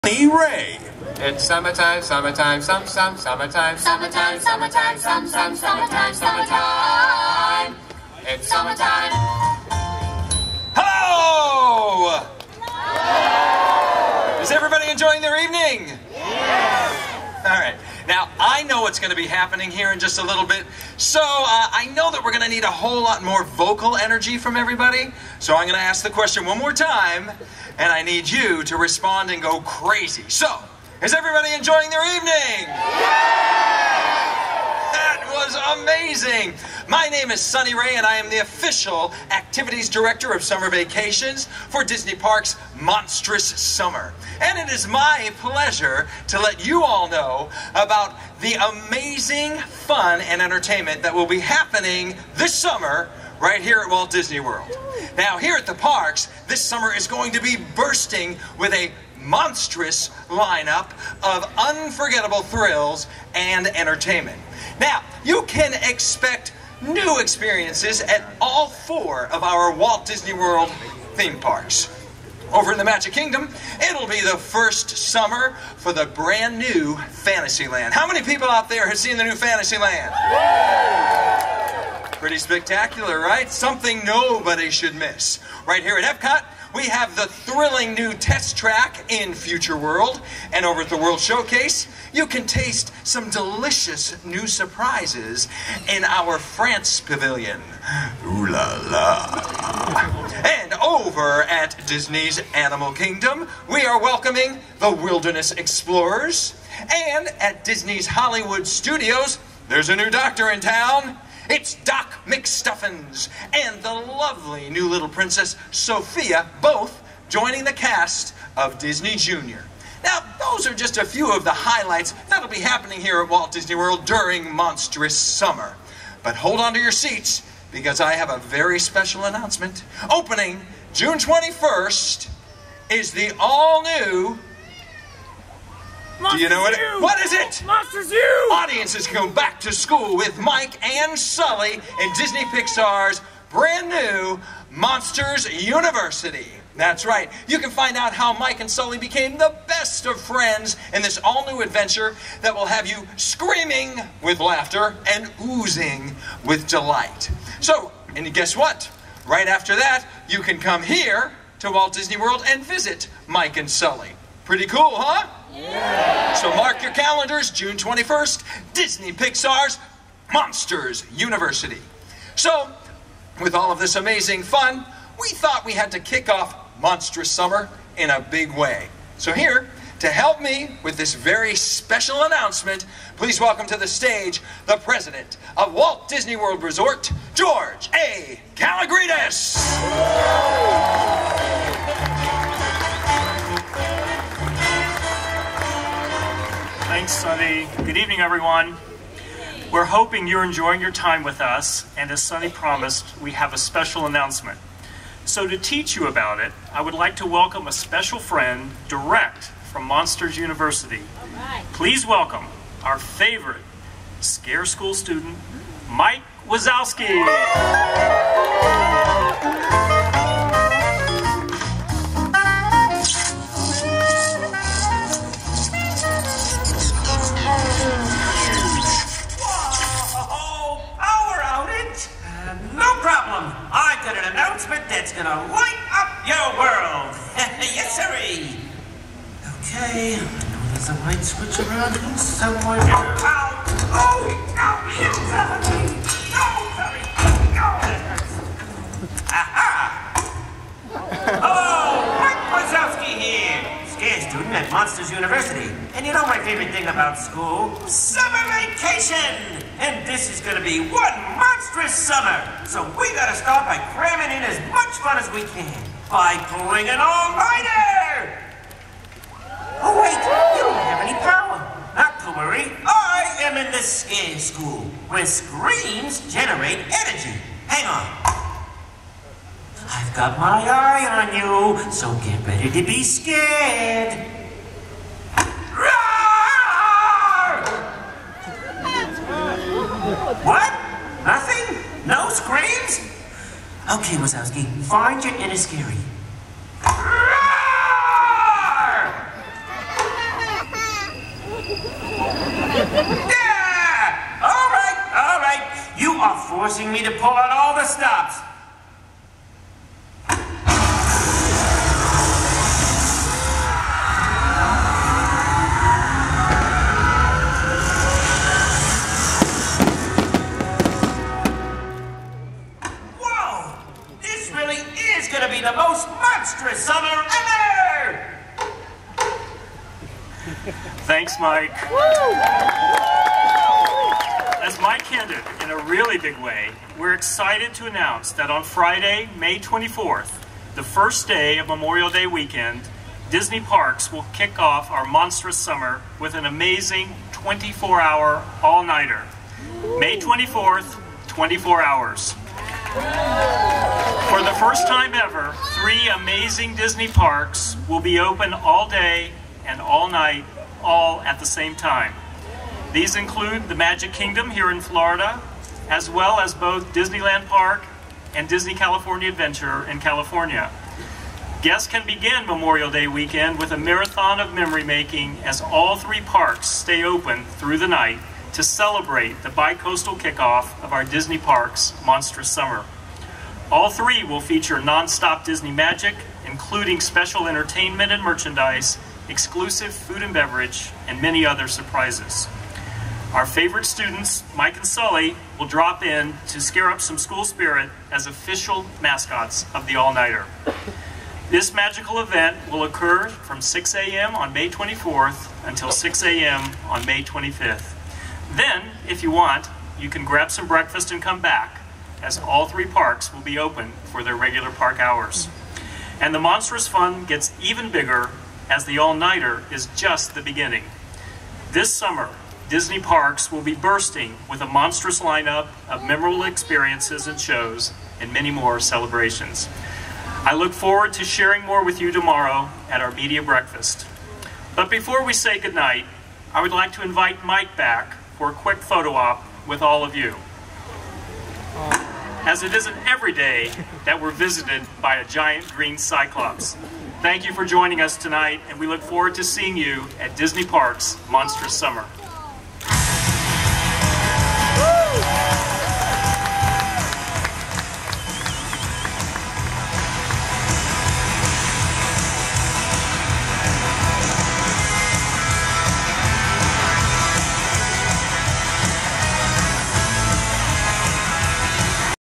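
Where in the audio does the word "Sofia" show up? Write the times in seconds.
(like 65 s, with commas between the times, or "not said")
115 s.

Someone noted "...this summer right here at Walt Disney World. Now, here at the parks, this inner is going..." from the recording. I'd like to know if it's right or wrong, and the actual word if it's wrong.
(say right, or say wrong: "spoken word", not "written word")
wrong: "summer", not "inner".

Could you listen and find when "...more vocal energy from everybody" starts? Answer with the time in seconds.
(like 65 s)
23 s.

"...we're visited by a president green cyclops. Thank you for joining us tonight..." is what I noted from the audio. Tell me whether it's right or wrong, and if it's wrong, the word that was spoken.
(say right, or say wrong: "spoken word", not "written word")
wrong: "giant", not "president".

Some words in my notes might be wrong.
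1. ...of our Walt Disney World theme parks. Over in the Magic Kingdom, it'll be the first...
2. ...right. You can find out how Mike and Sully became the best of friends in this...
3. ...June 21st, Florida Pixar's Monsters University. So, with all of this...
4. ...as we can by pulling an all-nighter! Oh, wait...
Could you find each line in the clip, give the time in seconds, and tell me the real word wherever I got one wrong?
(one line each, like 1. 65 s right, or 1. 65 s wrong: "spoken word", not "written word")
1. 69 s right
2. 147 s right
3. 167 s wrong: "Disney", not "Florida"
4. 265 s right.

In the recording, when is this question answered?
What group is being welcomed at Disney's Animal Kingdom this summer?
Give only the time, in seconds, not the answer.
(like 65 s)
104 s.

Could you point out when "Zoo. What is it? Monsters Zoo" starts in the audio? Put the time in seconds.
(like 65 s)
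136 s.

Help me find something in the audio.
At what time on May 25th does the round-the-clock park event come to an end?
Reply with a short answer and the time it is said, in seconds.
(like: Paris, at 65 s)
6 a.m., at 405 s.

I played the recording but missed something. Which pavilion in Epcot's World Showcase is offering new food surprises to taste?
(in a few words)
France.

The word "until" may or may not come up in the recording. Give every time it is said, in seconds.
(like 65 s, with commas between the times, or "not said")
405 s.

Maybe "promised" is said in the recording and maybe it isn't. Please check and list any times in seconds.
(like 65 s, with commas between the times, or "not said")
202 s.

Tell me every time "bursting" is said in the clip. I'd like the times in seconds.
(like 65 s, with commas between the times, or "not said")
57 s, 423 s.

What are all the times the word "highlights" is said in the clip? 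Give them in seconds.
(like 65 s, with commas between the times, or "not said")
121 s.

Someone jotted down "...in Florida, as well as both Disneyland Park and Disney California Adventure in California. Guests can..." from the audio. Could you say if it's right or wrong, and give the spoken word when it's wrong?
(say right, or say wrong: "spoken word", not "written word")
right.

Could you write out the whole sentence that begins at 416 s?
And the Monstrous Fun gets even bigger as the all-nighter is just the beginning.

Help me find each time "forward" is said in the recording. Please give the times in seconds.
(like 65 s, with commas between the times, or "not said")
430 s, 449 s.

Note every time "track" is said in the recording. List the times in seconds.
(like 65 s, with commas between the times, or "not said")
88 s.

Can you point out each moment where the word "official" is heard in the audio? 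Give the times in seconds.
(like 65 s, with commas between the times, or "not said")
38 s, 398 s.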